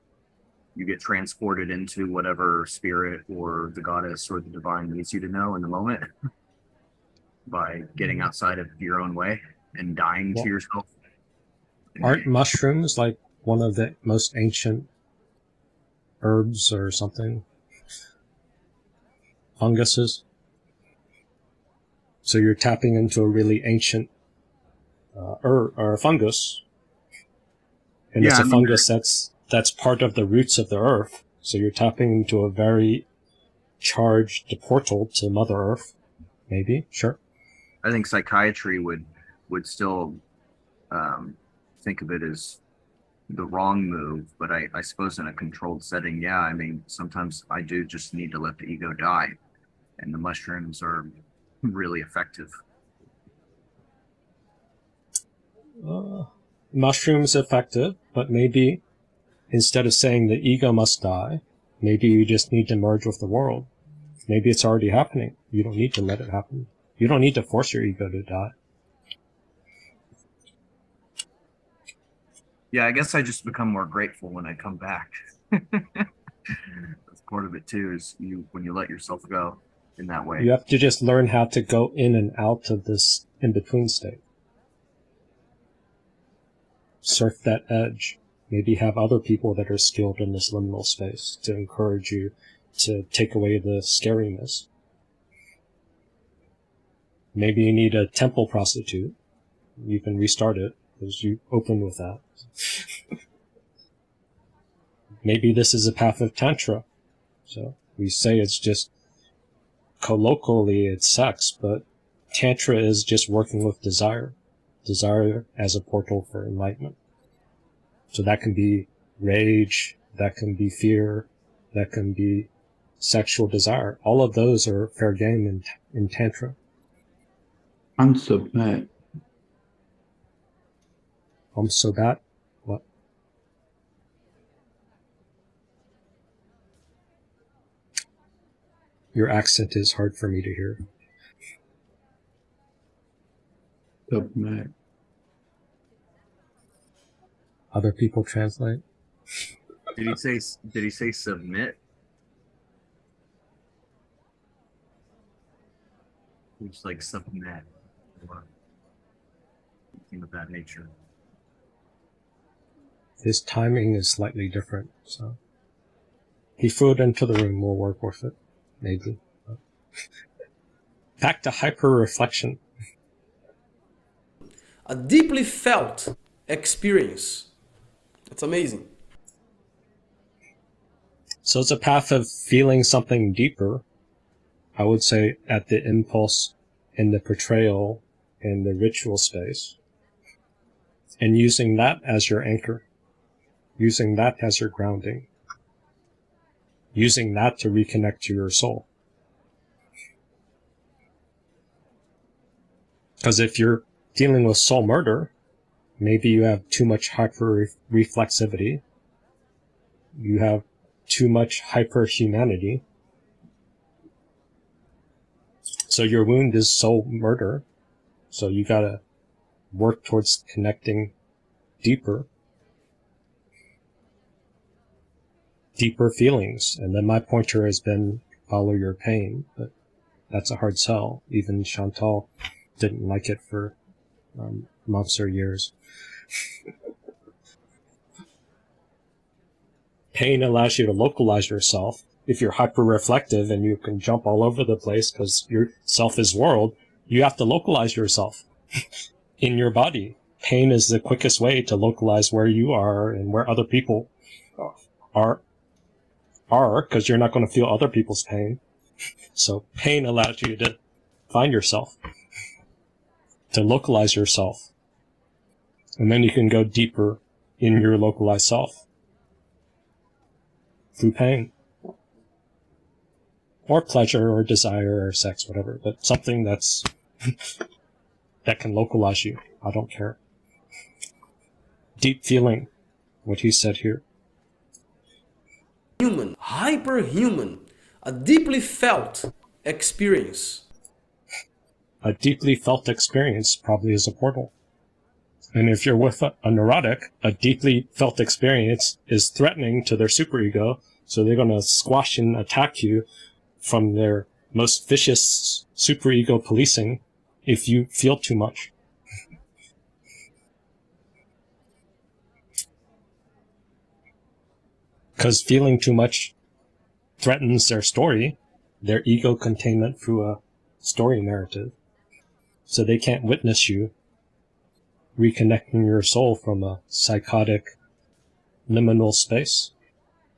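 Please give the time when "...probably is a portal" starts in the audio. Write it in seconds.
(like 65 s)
293 s.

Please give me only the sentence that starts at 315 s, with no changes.
because feeling too much threatens their story, their ego containment through a story narrative.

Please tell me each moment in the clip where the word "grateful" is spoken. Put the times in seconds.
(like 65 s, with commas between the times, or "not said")
73 s.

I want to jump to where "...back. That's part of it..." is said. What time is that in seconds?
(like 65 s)
74 s.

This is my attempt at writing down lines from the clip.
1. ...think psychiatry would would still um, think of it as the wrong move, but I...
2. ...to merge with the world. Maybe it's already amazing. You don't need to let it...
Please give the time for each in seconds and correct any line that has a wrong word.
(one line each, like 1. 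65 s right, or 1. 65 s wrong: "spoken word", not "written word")
1. 37 s right
2. 62 s wrong: "happening", not "amazing".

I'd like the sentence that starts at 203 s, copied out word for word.
Because if you're dealing with soul murder, maybe you have too much hyper reflexivity, you have too much hyper humanity.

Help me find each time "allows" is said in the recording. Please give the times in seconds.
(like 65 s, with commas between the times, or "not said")
240 s, 260 s.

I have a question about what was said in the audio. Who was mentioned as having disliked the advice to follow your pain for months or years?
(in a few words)
Chantal.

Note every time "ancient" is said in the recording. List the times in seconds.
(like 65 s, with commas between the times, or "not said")
14 s, 23 s.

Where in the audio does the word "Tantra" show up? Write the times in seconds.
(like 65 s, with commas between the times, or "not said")
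106 s, 112 s, 126 s.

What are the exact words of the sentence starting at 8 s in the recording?
outside of your own way and dying yeah.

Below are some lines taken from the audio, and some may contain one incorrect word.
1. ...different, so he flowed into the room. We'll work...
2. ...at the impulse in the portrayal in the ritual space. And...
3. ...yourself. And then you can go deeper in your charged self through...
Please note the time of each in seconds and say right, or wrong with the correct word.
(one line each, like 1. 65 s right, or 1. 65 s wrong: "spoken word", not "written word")
1. 164 s right
2. 185 s right
3. 264 s wrong: "localized", not "charged".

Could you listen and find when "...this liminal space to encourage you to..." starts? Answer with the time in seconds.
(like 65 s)
90 s.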